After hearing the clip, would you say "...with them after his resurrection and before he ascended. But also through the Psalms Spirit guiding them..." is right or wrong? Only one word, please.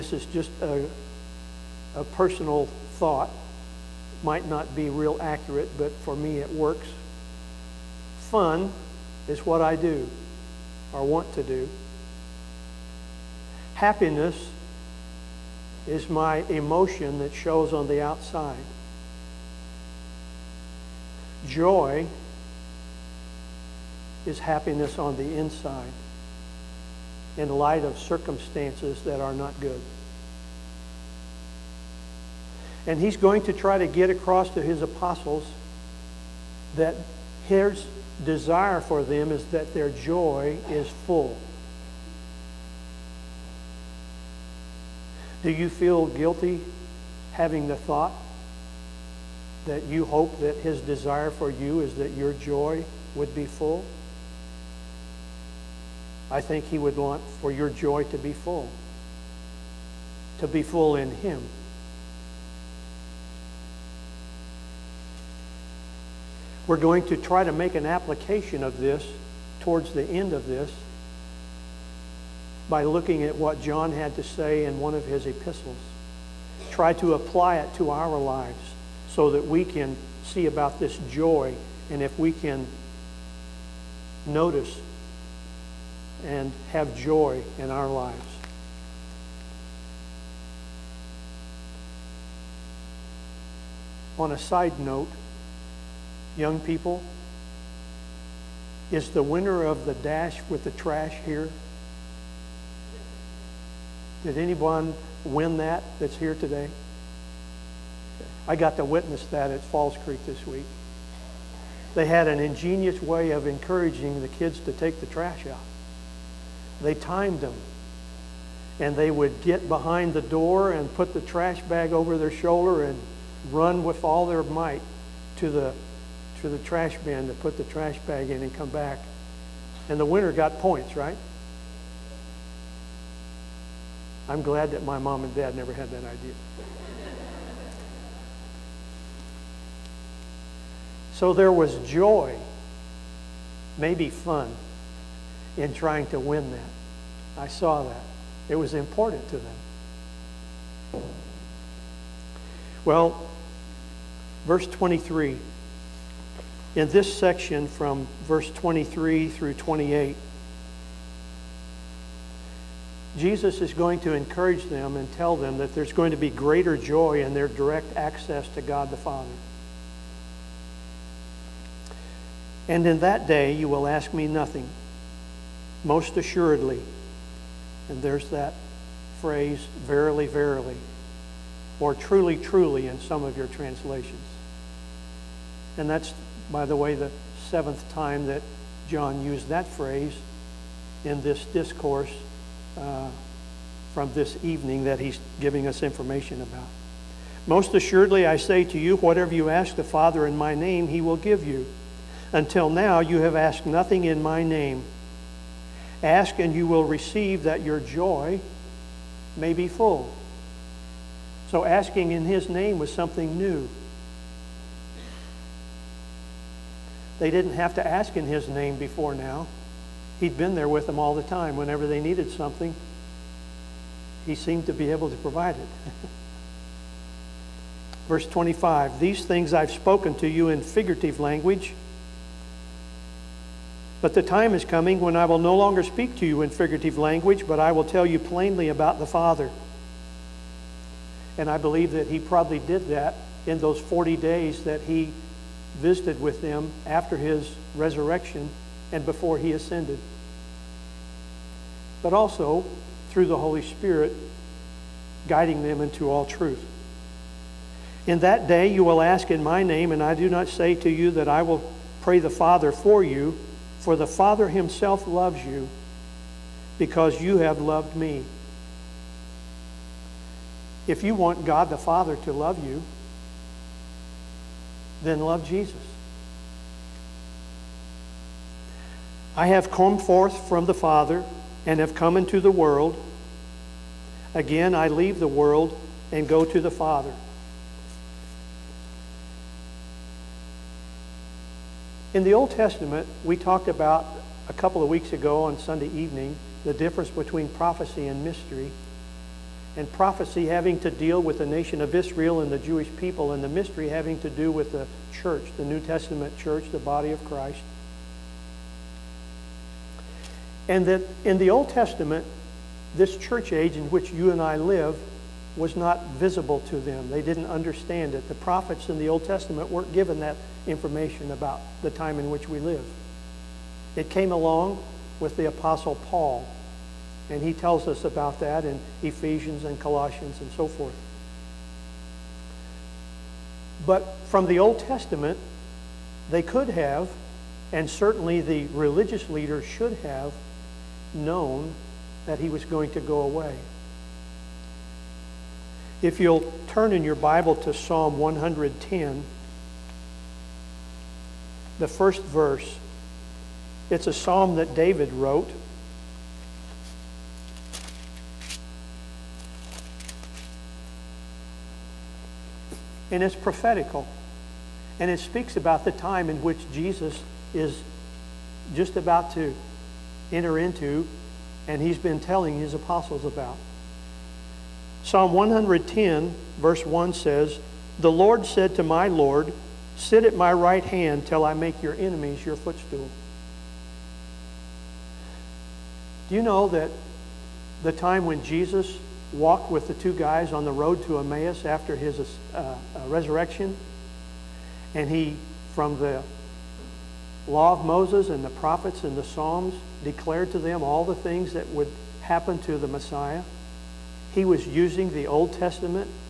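wrong.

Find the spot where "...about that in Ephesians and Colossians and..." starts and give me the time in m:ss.
5:28.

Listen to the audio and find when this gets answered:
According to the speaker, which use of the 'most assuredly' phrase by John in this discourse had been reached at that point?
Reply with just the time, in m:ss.
3:07.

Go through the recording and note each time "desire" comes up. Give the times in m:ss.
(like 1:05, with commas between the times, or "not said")
0:38, 0:50.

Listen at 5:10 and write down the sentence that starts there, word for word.
And that in the Old Testament, this church age in which you and I live was not visible to them.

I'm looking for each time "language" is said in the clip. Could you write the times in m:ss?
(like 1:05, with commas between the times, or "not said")
3:51, 3:56.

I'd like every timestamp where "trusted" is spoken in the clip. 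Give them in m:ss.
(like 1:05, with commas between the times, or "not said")
not said.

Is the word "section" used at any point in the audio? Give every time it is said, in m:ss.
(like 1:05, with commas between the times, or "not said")
2:37.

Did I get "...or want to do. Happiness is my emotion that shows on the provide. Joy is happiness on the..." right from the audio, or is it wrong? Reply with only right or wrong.
wrong.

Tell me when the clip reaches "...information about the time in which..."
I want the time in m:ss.
5:20.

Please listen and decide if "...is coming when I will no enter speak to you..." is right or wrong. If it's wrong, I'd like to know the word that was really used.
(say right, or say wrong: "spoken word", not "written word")
wrong: "longer", not "enter".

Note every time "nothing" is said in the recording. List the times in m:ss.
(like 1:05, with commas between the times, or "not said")
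2:54, 3:23.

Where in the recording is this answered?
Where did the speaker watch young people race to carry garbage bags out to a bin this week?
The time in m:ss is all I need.
1:49.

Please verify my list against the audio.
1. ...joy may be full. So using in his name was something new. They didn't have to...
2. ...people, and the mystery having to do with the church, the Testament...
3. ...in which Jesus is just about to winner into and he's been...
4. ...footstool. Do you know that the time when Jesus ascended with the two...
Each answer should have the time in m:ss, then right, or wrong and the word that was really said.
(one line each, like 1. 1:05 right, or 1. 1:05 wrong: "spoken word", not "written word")
1. 3:27 wrong: "asking", not "using"
2. 5:02 wrong: "New", not "Testament"
3. 6:06 wrong: "enter", not "winner"
4. 6:22 wrong: "walked", not "ascended".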